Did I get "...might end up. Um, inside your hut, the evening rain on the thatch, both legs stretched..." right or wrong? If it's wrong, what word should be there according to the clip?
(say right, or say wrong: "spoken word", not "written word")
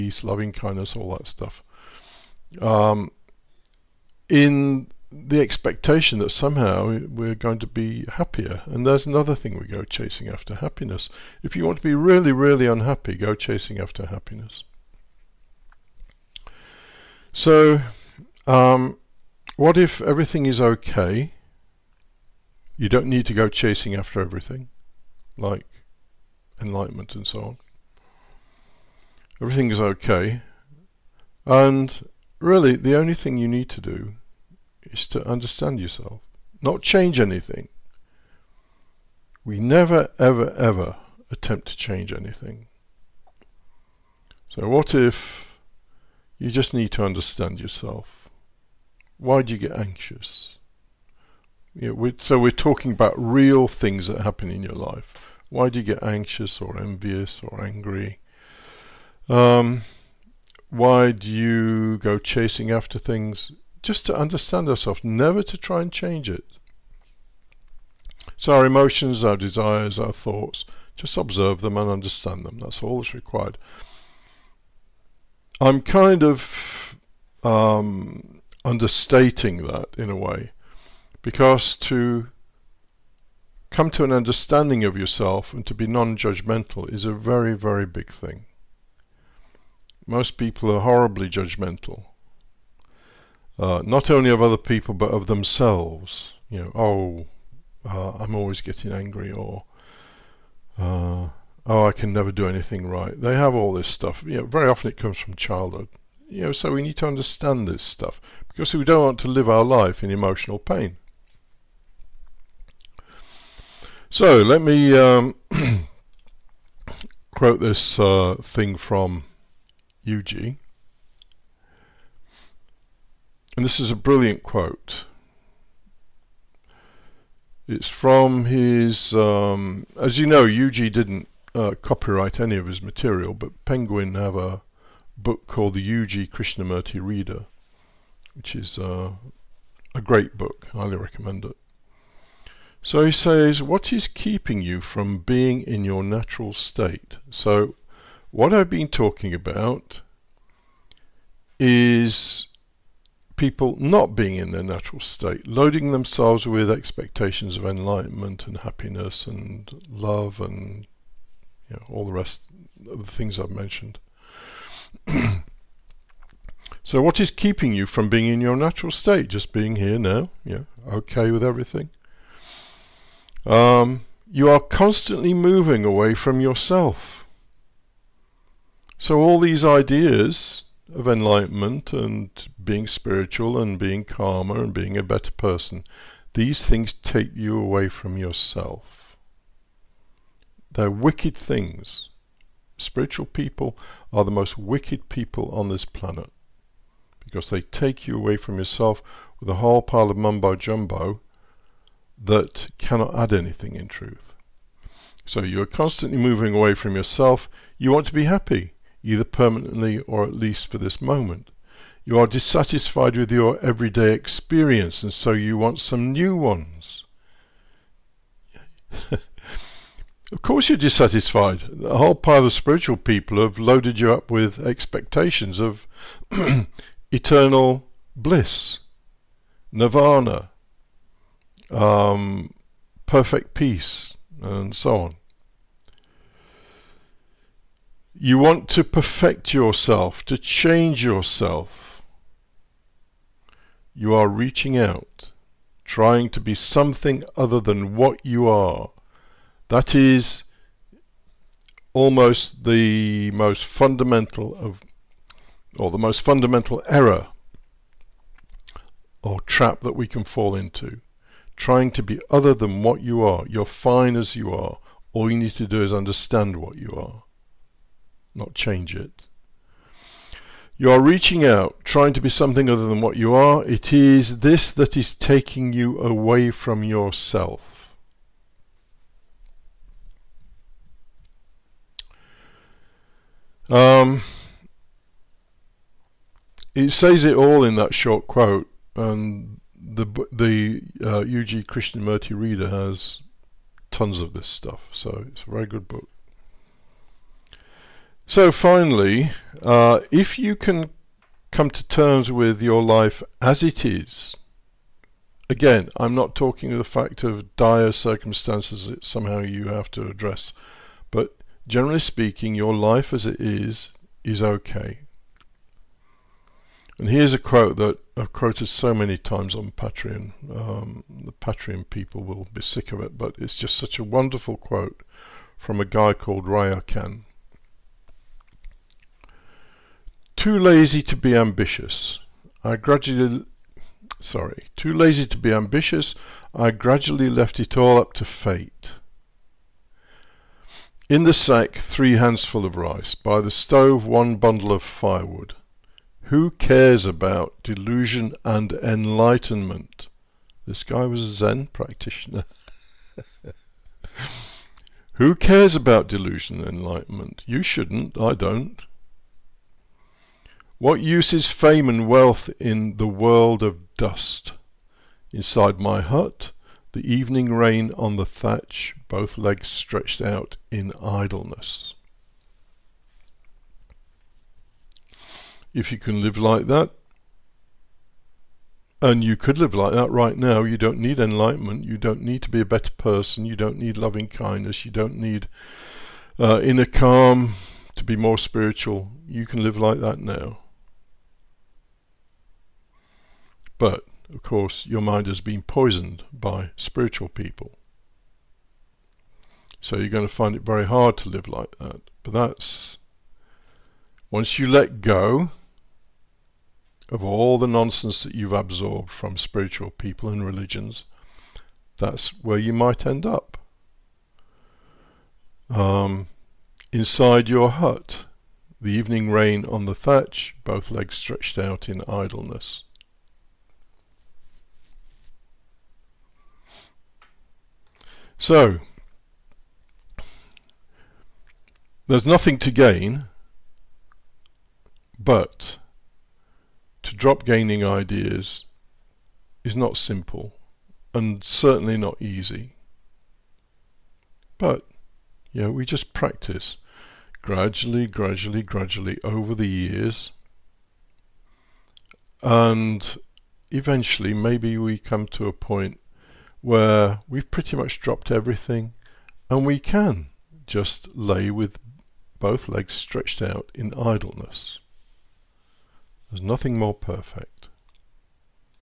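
right.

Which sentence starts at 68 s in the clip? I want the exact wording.
So our emotions, our desires, our thoughts, just observe them and understand them.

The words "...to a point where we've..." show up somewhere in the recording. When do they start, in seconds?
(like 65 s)
455 s.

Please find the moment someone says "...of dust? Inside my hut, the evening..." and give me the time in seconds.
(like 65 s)
363 s.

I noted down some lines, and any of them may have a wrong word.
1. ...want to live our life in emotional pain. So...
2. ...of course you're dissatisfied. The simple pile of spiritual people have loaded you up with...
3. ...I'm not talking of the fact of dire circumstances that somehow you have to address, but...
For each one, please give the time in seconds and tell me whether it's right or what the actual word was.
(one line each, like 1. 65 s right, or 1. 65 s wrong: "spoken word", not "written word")
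1. 109 s right
2. 219 s wrong: "whole", not "simple"
3. 305 s right.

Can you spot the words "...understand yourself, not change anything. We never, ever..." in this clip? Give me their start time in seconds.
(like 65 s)
35 s.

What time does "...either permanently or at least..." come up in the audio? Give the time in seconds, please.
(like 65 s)
209 s.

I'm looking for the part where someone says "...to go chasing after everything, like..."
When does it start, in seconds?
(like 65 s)
23 s.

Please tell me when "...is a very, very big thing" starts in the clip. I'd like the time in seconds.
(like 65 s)
86 s.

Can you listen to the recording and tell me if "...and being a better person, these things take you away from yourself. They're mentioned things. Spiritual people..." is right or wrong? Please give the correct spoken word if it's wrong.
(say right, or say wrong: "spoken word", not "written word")
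wrong: "wicked", not "mentioned".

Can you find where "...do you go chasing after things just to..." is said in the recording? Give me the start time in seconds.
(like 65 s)
61 s.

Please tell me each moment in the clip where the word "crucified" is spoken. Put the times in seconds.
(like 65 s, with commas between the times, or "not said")
not said.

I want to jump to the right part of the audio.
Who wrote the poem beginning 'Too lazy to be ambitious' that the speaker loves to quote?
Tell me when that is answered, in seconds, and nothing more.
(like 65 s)
326 s.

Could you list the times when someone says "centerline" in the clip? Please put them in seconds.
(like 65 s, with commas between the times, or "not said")
not said.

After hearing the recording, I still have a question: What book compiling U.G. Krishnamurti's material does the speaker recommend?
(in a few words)
The U.G. Krishnamurti Reader.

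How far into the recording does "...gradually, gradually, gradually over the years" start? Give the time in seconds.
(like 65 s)
447 s.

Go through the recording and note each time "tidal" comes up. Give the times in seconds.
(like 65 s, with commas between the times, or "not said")
not said.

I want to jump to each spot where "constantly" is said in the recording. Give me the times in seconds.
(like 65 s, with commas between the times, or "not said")
174 s, 205 s.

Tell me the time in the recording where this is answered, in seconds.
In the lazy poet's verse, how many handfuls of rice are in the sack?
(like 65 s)
341 s.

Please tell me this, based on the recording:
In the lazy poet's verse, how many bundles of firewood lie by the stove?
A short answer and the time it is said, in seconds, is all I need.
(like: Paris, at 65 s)
1, at 344 s.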